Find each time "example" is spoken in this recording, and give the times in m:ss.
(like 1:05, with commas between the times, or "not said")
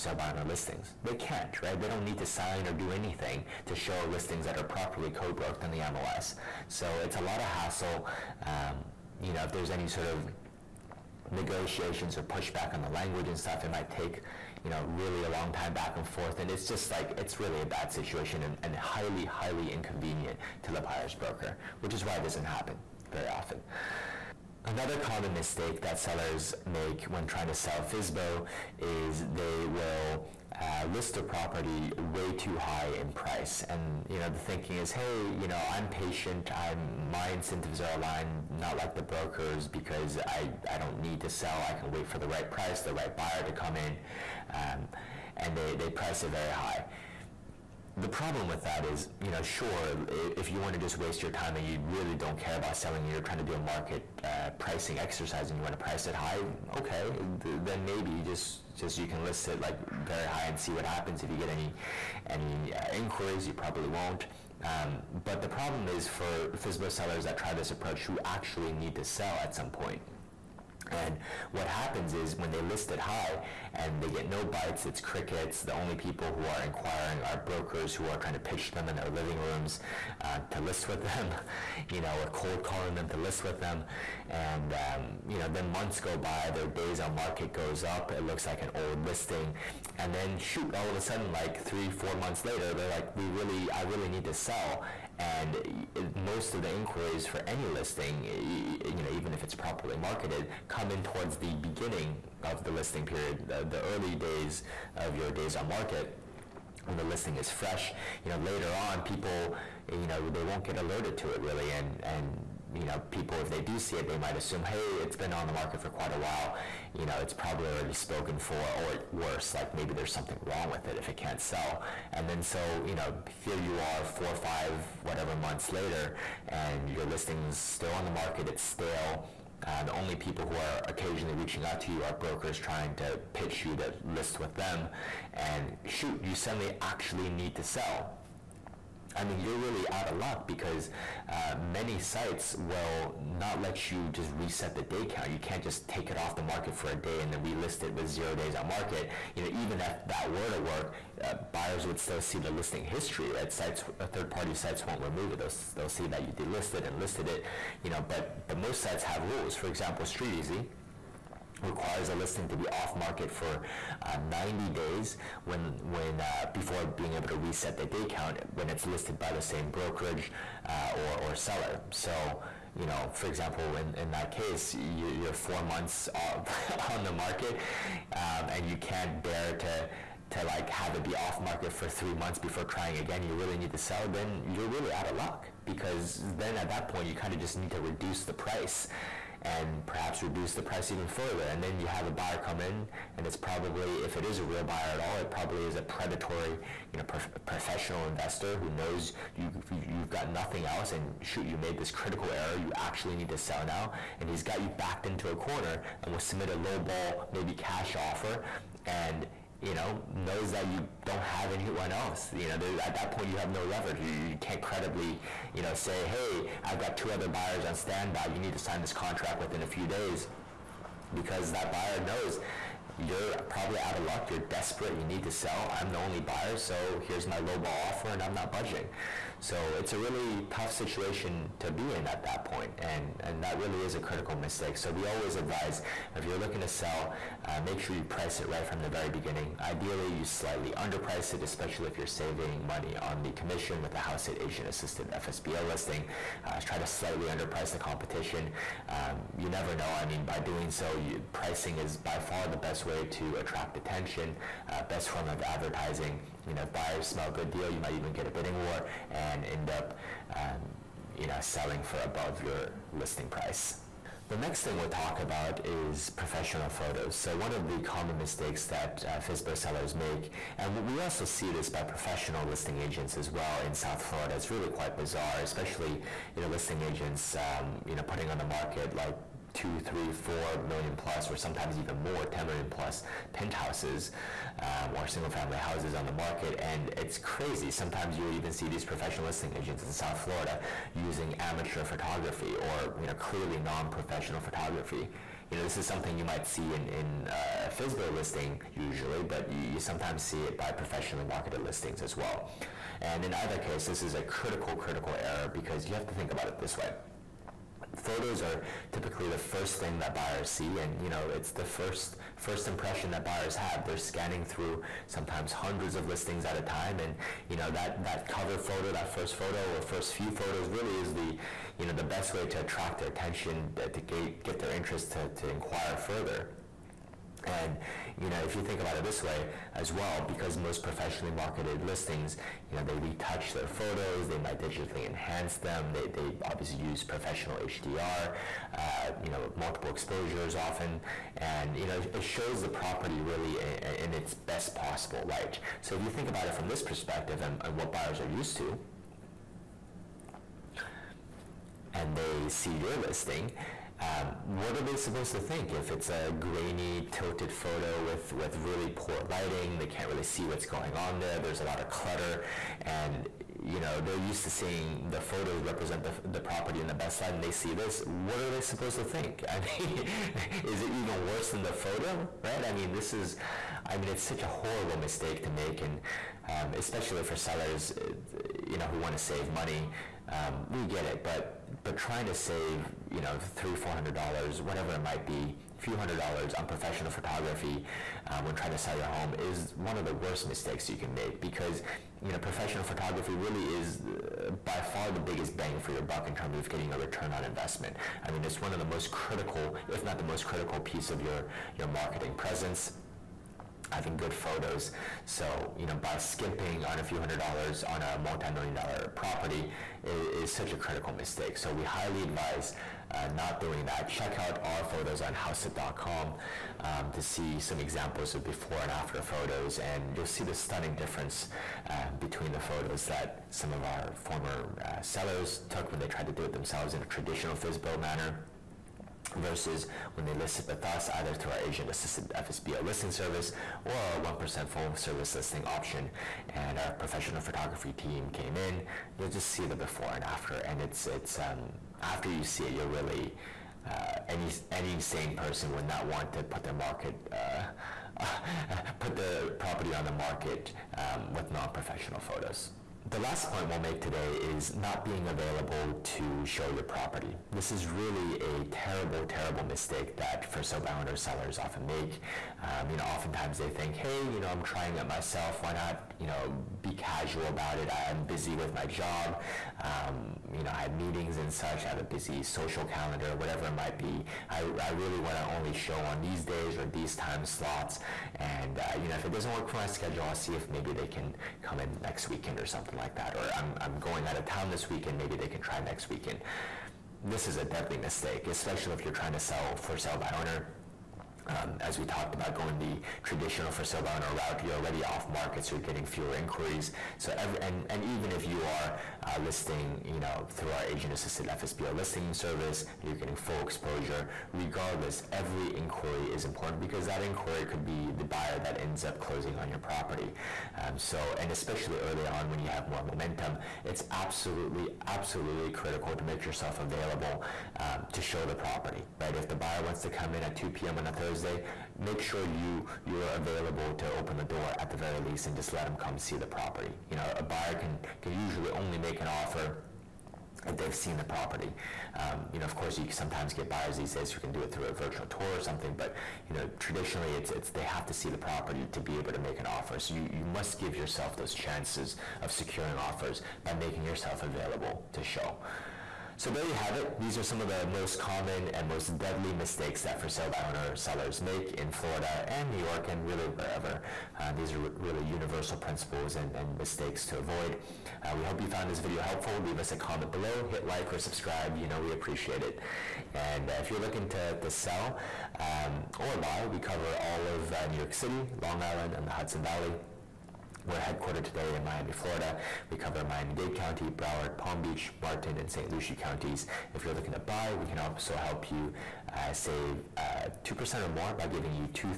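2:39, 2:53, 6:57.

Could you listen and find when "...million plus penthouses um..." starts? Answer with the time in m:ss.
4:42.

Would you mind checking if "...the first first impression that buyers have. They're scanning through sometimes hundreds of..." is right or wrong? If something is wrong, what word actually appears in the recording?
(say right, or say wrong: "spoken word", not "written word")
right.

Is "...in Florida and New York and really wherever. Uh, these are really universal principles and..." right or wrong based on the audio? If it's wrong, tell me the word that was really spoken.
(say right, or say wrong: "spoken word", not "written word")
right.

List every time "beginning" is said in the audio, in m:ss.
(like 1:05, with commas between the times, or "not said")
1:41, 3:59.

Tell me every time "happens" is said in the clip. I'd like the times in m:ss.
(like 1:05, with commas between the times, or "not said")
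0:22, 1:00, 1:11.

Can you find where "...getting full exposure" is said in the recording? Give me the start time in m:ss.
8:23.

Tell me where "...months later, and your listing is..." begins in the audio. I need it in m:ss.
2:05.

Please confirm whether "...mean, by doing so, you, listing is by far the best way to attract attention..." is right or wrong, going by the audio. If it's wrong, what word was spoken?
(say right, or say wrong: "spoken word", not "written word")
wrong: "pricing", not "listing".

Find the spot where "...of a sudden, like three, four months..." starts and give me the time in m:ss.
1:30.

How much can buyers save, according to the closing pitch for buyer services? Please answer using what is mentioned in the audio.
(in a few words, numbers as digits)
2% or more.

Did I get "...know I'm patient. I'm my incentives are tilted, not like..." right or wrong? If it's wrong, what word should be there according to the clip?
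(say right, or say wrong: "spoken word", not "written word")
wrong: "aligned", not "tilted".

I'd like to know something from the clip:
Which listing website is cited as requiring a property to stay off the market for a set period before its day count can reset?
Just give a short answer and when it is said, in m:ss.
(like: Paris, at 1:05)
StreetEasy, at 2:40.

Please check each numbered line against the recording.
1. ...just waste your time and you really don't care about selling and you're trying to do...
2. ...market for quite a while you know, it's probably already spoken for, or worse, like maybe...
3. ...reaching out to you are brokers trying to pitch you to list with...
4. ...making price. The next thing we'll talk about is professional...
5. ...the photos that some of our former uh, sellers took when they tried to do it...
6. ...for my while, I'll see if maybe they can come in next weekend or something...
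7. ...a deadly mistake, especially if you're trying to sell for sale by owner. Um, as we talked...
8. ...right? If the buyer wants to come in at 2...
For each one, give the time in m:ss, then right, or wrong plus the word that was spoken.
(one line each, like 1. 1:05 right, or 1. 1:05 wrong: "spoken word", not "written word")
1. 0:50 right
2. 1:55 right
3. 2:11 right
4. 4:22 wrong: "listing", not "making"
5. 7:02 right
6. 7:59 wrong: "schedule", not "while"
7. 8:07 right
8. 8:39 right.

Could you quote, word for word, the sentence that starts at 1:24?
And um, you know, then months go by, their days on market goes up.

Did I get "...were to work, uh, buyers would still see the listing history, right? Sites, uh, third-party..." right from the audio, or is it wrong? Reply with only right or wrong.
right.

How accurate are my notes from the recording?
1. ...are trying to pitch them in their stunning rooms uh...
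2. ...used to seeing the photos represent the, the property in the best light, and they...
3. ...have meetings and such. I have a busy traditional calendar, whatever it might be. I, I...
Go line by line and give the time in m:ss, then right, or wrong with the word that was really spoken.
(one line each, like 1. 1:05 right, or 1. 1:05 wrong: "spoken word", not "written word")
1. 1:18 wrong: "living", not "stunning"
2. 6:04 right
3. 7:50 wrong: "social", not "traditional".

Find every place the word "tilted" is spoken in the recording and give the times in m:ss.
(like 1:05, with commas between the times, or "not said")
5:57.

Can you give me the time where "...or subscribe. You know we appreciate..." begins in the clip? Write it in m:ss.
9:21.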